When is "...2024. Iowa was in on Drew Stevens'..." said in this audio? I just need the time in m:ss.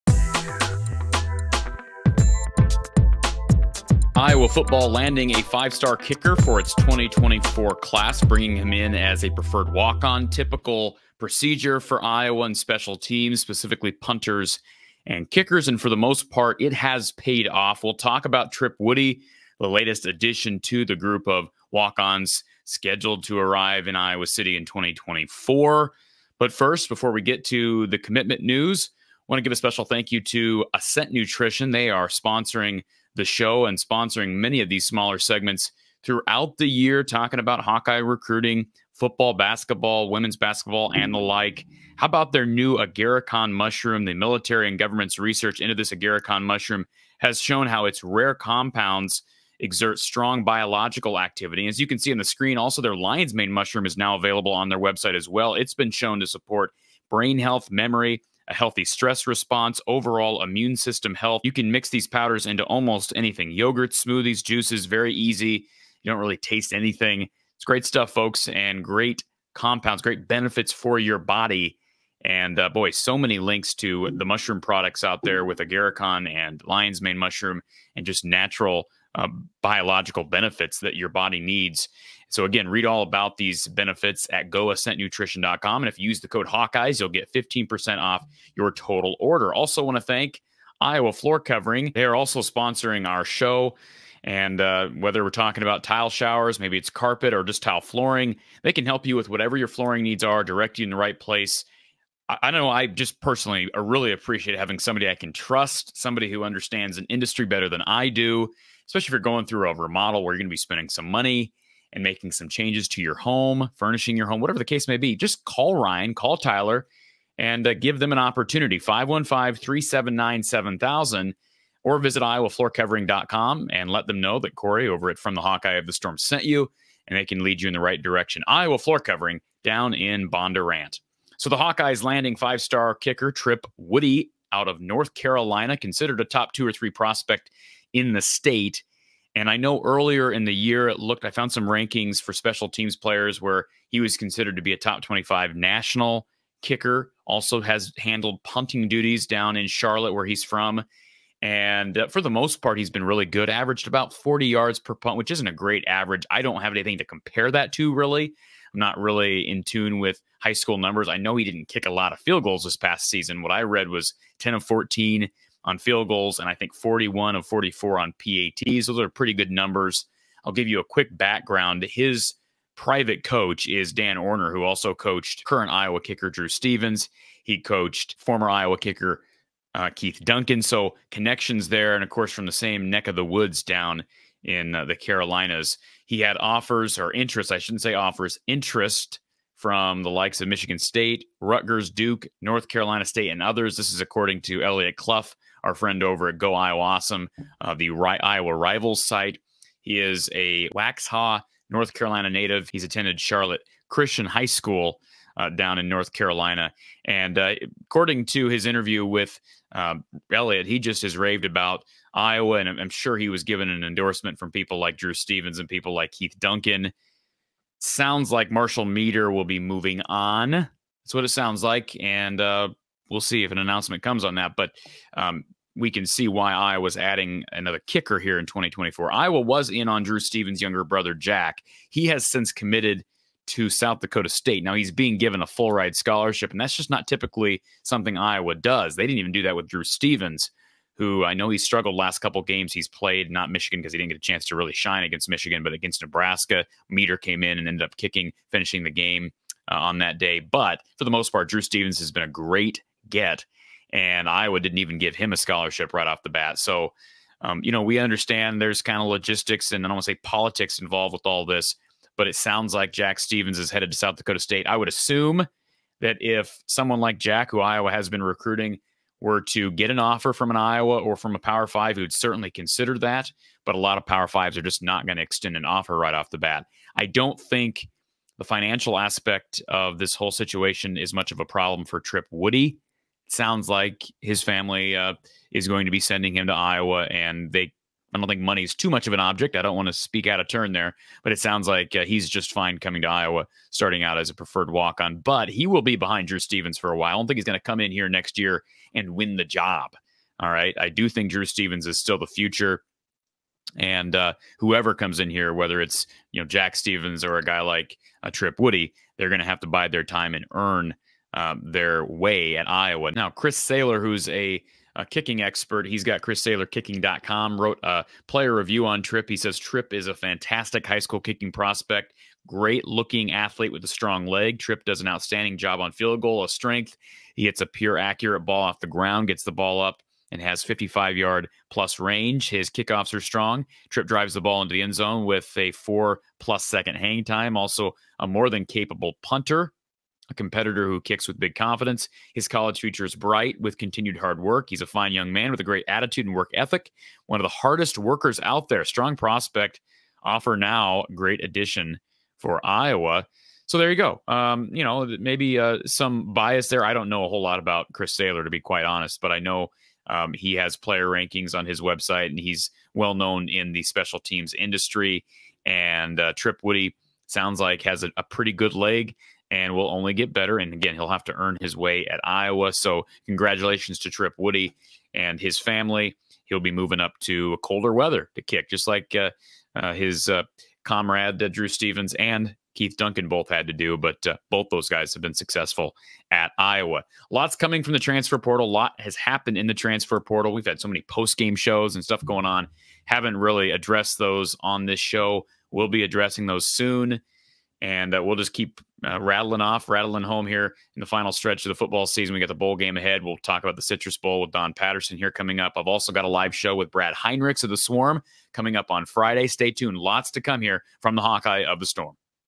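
3:48.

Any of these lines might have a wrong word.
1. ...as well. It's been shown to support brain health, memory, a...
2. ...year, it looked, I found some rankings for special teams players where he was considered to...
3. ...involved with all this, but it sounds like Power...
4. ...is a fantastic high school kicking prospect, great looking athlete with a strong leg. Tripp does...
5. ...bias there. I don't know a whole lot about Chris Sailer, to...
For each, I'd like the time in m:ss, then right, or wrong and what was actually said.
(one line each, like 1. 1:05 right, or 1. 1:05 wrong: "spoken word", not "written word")
1. 0:55 right
2. 2:20 right
3. 4:20 wrong: "Jack", not "Power"
4. 5:19 right
5. 5:56 right.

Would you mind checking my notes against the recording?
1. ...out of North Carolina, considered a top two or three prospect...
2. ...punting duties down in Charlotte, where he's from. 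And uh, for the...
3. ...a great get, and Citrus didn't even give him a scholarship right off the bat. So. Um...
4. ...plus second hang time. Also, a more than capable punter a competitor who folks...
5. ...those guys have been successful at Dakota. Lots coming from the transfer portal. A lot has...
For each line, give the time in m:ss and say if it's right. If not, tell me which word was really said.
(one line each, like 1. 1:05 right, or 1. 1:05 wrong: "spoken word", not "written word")
1. 2:14 right
2. 2:28 right
3. 4:12 wrong: "Iowa", not "Citrus"
4. 5:36 wrong: "kicks", not "folks"
5. 6:24 wrong: "Iowa", not "Dakota".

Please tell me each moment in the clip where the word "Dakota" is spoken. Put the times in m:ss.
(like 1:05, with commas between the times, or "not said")
3:53, 4:24.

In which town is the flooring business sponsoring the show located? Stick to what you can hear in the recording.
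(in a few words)
Bondurant.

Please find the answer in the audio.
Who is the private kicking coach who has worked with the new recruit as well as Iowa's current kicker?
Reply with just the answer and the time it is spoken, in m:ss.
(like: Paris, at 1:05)
Dan Orner, at 2:53.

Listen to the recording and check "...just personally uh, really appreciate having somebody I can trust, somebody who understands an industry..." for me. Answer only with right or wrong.
right.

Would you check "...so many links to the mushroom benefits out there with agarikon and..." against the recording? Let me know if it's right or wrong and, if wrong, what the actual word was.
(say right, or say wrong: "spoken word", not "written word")
wrong: "products", not "benefits".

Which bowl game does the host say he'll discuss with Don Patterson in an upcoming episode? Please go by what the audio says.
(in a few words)
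Citrus Bowl.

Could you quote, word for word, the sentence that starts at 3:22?
He's attended Charlotte Christian High School uh, down in North Carolina.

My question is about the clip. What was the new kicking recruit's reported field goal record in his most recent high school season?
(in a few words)
10 of 14.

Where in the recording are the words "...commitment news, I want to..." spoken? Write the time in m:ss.
0:27.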